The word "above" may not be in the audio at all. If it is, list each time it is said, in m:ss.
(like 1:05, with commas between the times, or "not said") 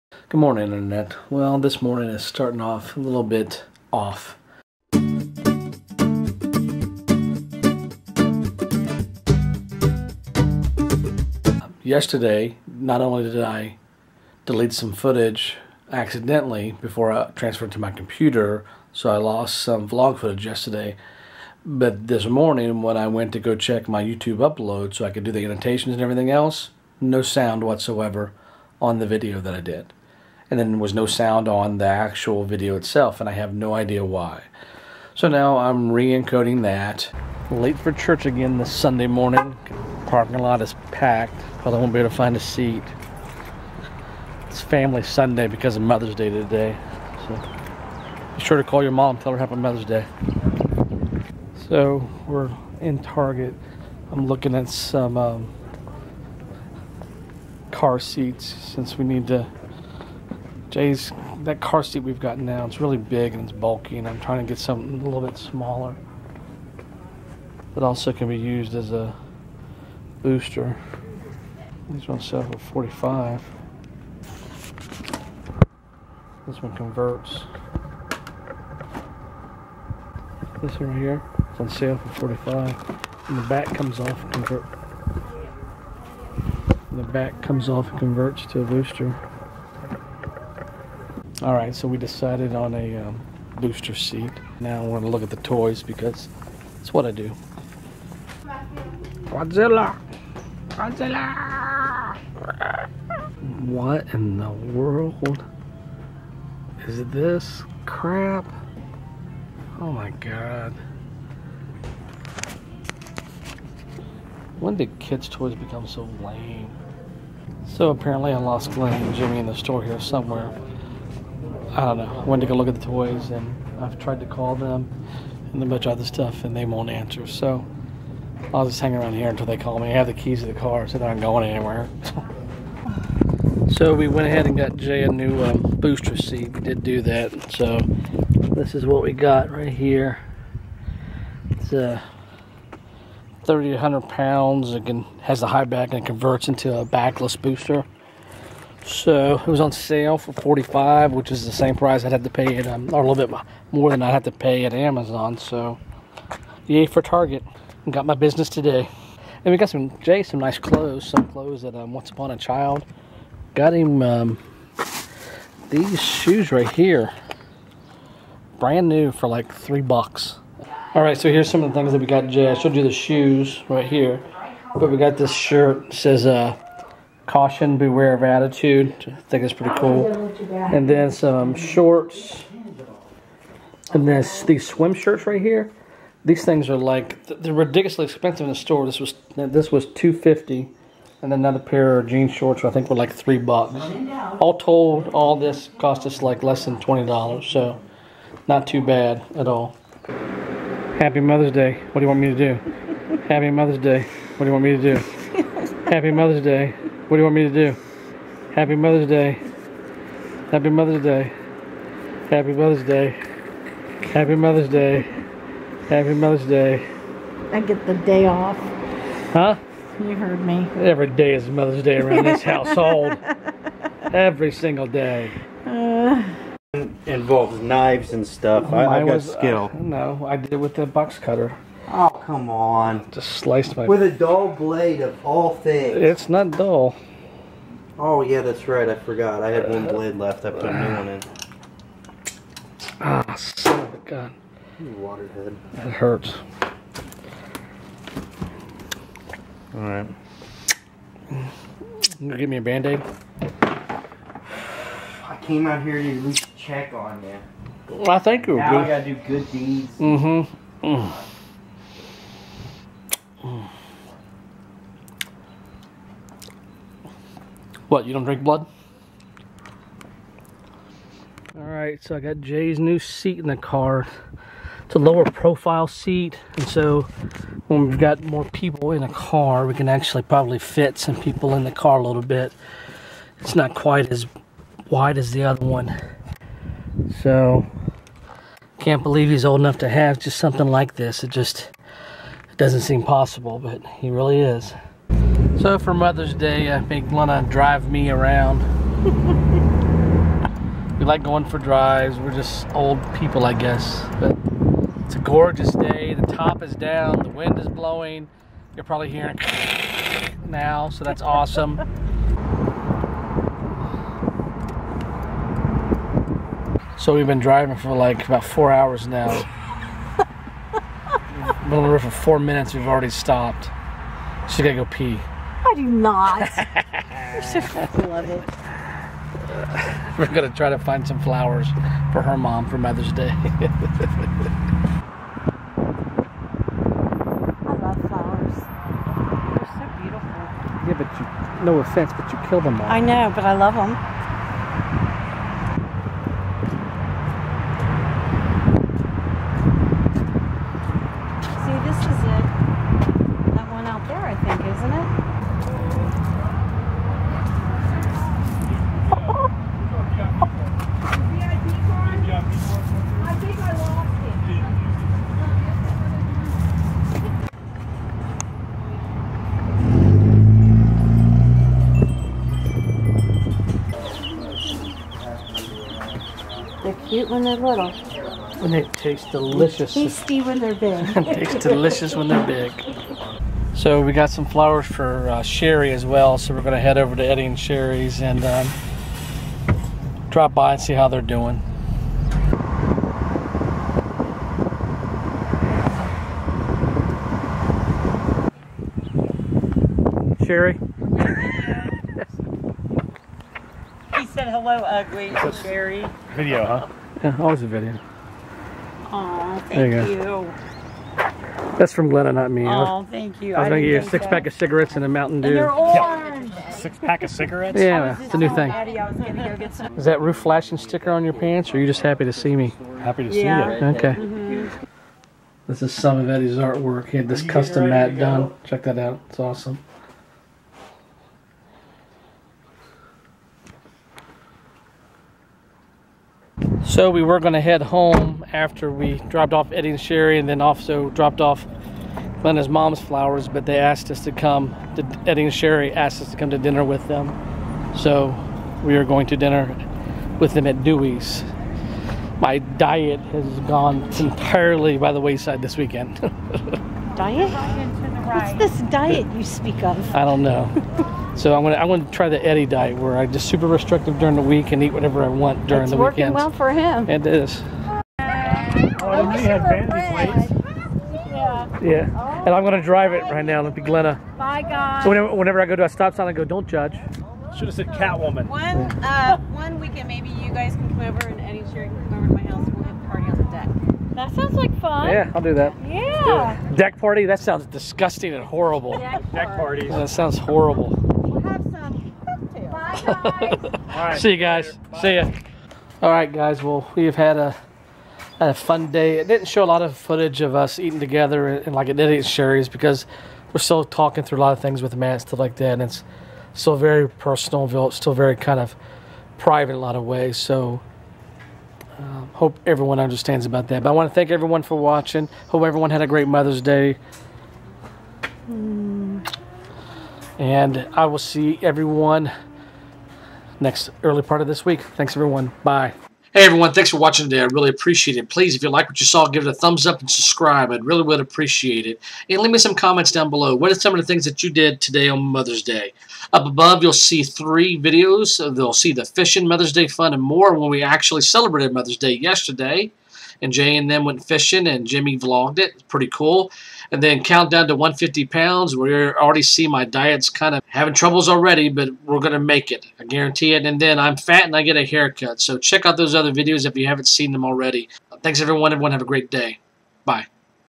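8:56.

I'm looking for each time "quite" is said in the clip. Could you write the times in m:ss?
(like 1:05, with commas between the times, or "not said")
4:43.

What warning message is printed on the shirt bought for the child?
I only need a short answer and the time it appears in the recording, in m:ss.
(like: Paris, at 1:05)
beware of attitude, at 2:57.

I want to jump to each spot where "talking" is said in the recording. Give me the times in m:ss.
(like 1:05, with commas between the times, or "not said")
8:23.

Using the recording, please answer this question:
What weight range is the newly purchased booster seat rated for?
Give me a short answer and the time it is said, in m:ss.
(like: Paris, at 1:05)
30 to 100 pounds, at 2:23.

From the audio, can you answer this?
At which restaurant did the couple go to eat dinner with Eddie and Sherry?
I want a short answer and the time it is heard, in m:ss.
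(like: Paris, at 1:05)
Dewey's, at 7:30.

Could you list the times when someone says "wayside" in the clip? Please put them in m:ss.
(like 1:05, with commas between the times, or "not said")
7:35.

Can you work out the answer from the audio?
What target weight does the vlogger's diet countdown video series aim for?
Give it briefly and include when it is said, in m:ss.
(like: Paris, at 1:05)
150 pounds, at 9:07.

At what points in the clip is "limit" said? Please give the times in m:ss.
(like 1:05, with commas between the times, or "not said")
not said.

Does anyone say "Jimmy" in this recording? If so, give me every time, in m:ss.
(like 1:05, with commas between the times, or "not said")
1:59, 9:04.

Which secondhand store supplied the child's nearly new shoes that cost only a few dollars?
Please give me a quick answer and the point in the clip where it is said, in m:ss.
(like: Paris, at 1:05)
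Once Upon a Child, at 2:41.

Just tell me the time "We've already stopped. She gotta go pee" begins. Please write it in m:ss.
5:22.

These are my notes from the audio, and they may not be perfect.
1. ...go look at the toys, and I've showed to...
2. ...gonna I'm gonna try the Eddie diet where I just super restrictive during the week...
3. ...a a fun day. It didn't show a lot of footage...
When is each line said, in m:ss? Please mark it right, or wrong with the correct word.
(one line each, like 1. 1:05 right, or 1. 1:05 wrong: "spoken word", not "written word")
1. 2:02 wrong: "tried", not "showed"
2. 7:41 right
3. 8:17 right.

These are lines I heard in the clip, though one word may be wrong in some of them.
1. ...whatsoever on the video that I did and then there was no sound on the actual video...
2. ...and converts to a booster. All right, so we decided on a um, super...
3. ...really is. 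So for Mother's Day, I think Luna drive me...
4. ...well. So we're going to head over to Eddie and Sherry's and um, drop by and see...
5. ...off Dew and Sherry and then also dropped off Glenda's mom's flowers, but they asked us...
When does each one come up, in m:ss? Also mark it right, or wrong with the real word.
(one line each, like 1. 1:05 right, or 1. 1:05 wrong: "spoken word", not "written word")
1. 0:27 right
2. 1:27 wrong: "booster", not "super"
3. 4:54 right
4. 6:26 right
5. 7:19 wrong: "Eddie", not "Dew".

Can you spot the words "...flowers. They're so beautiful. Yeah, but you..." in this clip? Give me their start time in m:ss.
5:38.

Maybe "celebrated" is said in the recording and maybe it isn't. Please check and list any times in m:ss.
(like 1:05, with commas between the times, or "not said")
9:01.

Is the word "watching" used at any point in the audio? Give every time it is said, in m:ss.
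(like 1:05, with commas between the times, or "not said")
8:34, 8:46.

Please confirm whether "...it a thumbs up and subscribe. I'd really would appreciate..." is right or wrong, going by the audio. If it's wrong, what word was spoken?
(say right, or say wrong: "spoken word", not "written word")
right.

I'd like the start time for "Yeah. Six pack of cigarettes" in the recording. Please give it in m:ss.
6:56.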